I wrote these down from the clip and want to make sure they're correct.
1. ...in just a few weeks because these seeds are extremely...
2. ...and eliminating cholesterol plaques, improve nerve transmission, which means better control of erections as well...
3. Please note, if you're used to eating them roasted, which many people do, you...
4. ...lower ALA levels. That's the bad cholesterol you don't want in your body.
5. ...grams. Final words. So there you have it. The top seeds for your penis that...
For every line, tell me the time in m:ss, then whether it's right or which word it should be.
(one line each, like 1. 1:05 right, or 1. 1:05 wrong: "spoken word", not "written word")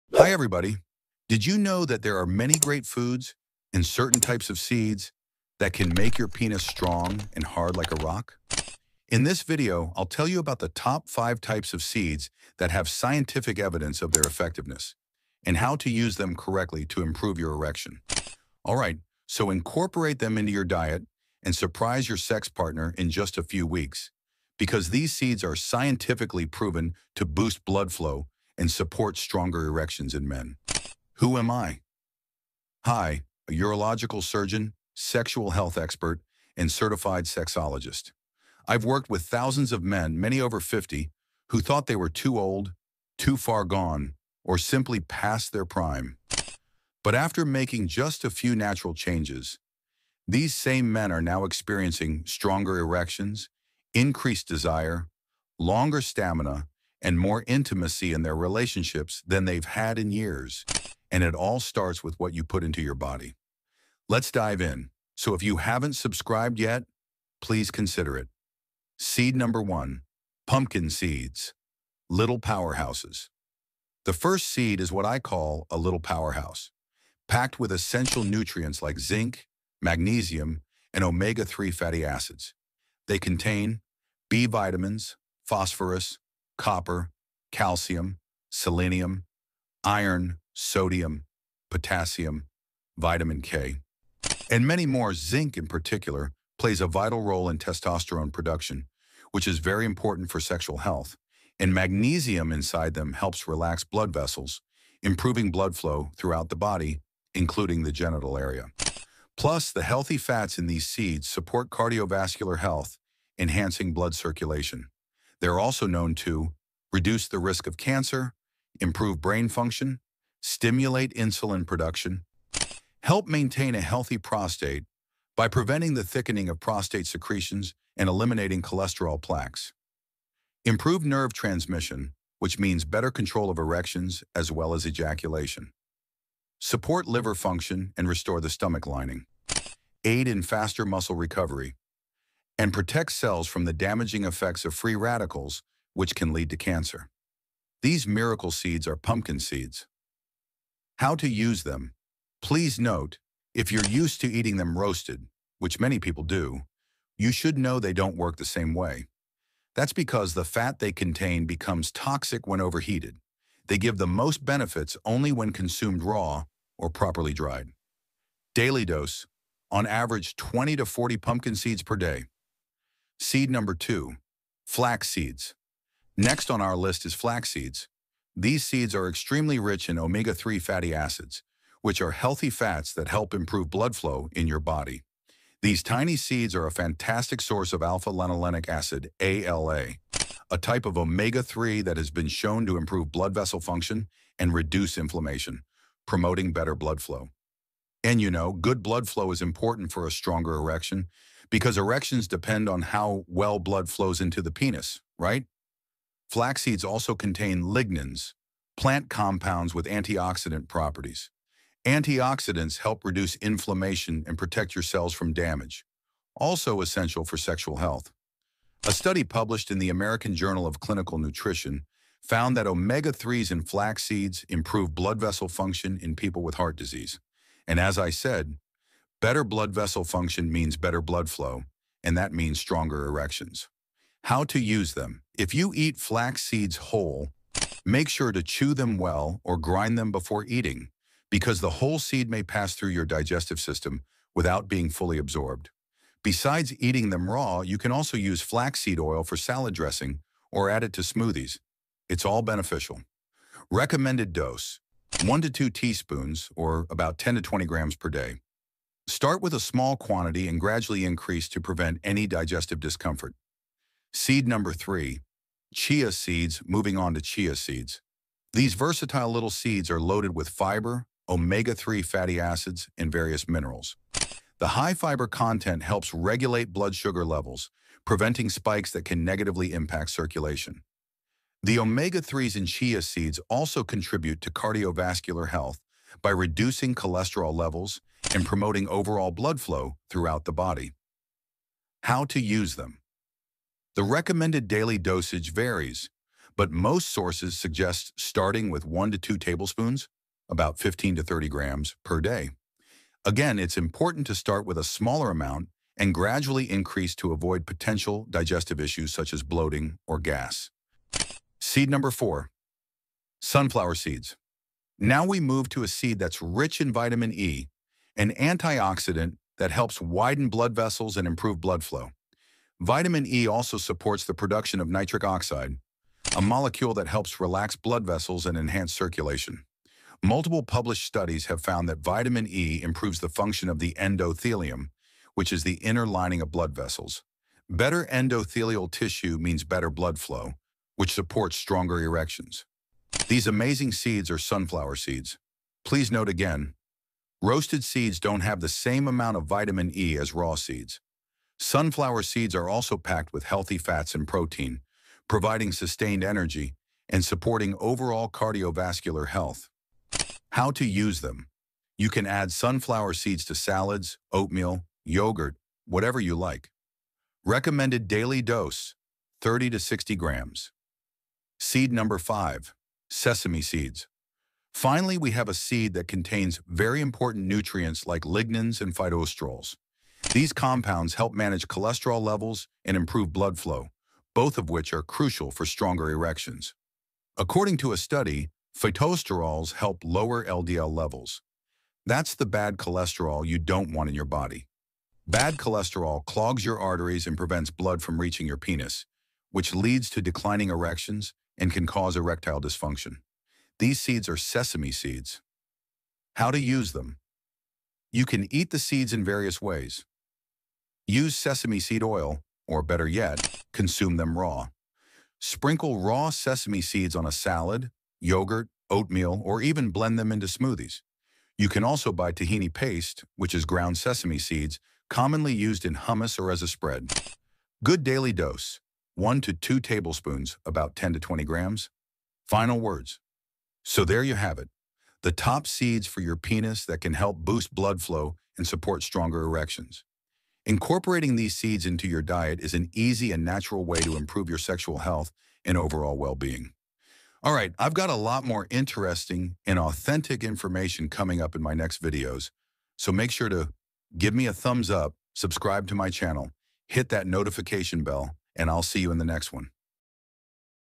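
1. 0:22 wrong: "scientifically", not "extremely"
2. 2:07 right
3. 2:32 right
4. 6:30 wrong: "LDL", not "ALA"
5. 7:11 right.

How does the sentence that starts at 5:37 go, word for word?
Better endothelial tissue means better blood flow, which supports stronger erections.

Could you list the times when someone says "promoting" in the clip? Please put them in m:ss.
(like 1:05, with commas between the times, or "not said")
3:16, 4:48.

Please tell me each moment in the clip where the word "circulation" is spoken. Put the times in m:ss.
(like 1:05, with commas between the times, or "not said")
1:54, 4:40, 5:28.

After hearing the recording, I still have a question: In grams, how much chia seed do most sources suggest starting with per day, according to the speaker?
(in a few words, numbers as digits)
15 to 30 grams.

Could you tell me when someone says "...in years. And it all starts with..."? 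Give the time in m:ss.
0:59.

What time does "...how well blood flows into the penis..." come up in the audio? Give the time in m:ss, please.
3:22.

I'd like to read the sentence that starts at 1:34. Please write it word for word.
And many more, zinc in particular, plays a vital role in testosterone production, which is very important for sexual health.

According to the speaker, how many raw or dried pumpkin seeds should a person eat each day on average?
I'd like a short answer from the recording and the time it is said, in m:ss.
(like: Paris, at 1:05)
20 to 40, at 2:50.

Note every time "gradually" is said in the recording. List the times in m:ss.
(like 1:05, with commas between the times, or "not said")
4:20, 5:06.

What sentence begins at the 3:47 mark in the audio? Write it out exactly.
And as I said, Better blood vessel function means better blood flow, and that means stronger erections.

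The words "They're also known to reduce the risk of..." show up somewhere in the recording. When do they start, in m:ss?
1:55.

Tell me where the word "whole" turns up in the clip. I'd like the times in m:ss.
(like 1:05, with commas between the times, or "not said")
3:56, 4:01.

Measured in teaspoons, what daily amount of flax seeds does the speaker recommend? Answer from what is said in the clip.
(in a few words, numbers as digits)
1 to 2 teaspoons.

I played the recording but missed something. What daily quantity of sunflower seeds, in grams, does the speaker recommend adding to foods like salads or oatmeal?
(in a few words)
30 to 60 grams.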